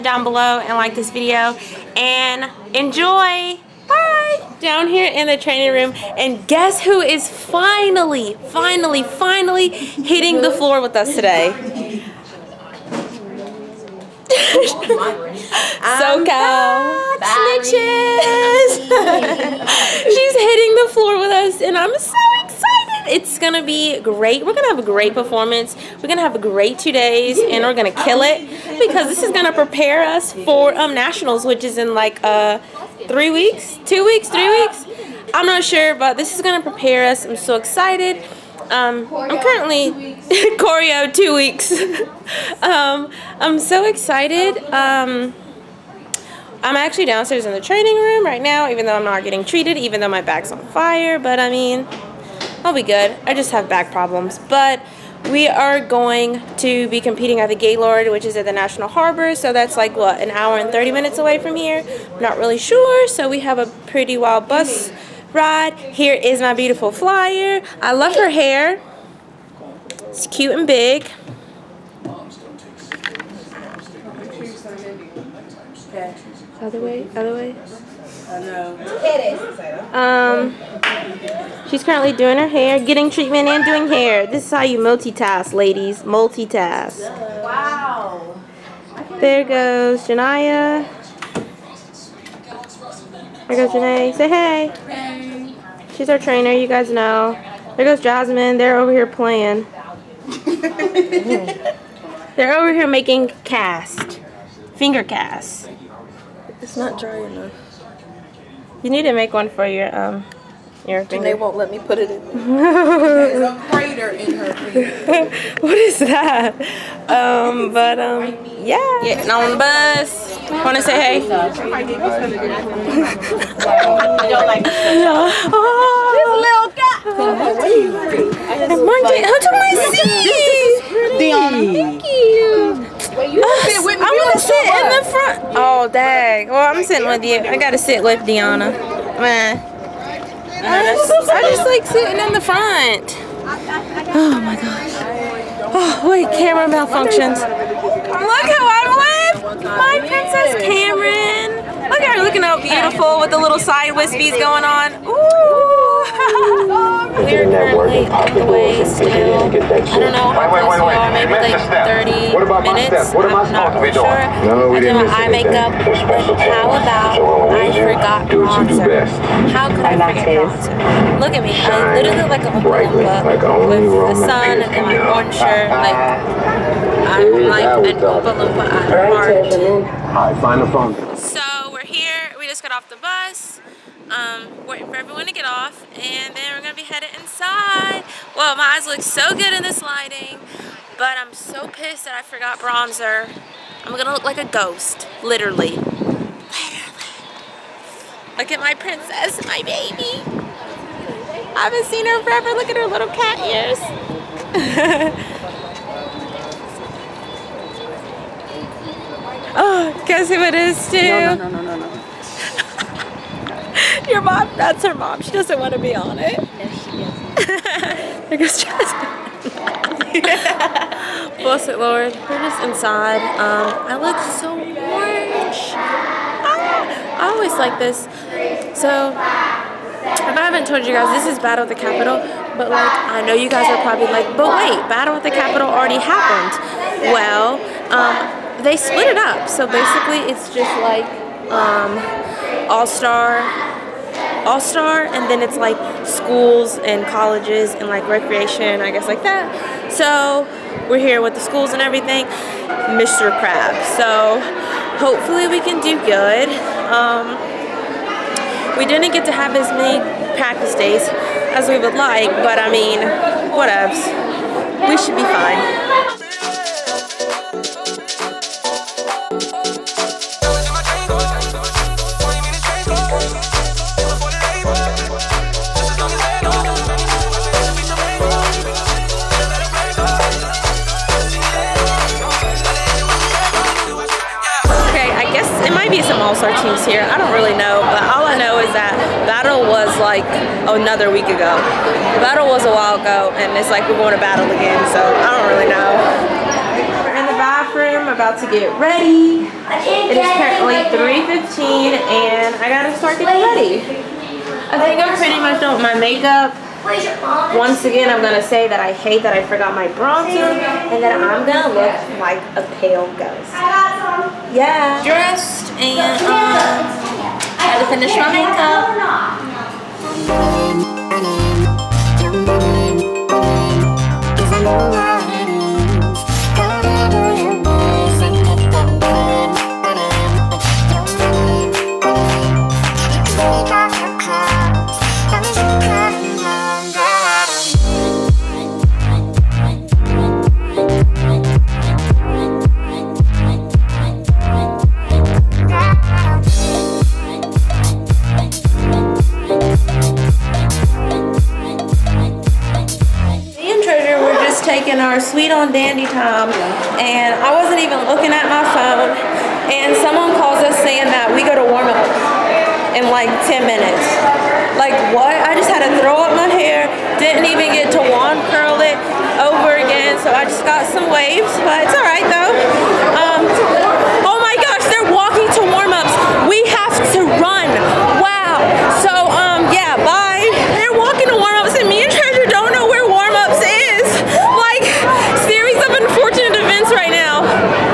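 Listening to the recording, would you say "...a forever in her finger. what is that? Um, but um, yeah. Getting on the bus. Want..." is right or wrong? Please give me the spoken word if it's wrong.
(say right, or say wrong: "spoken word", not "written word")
wrong: "crater", not "forever".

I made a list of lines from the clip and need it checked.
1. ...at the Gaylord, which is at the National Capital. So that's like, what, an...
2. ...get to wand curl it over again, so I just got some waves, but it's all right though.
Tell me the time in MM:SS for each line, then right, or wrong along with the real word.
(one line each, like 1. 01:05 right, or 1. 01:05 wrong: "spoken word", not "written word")
1. 00:57 wrong: "Harbor", not "Capital"
2. 06:07 right.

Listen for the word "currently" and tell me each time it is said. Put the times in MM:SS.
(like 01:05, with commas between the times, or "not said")
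00:39, 01:21, 02:37, 05:00.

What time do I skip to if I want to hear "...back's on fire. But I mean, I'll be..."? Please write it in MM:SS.
00:50.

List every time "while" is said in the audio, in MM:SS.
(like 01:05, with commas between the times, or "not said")
04:52.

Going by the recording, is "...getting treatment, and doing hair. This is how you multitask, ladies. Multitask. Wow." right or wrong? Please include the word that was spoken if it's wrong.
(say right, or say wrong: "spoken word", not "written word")
right.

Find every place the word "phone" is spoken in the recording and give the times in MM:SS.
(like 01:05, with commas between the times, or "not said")
03:00, 05:58.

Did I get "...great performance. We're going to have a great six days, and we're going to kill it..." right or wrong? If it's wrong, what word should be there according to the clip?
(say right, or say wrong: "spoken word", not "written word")
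wrong: "two", not "six".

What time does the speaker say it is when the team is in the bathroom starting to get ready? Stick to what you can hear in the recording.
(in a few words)
3:15.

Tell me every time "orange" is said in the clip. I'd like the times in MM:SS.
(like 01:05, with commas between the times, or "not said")
02:55, 03:44.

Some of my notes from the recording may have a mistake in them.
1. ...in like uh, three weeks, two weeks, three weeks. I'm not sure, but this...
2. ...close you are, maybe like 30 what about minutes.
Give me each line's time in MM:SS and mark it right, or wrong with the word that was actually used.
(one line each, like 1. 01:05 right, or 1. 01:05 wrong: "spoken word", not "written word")
1. 00:31 right
2. 02:40 right.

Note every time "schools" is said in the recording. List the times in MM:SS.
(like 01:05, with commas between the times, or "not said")
04:06, 04:11.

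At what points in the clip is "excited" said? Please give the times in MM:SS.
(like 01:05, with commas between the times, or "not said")
00:37, 00:43.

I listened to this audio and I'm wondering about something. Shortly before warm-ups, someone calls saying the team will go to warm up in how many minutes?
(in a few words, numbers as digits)
10 minutes.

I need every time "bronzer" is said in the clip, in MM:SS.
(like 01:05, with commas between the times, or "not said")
02:50, 03:12, 05:09.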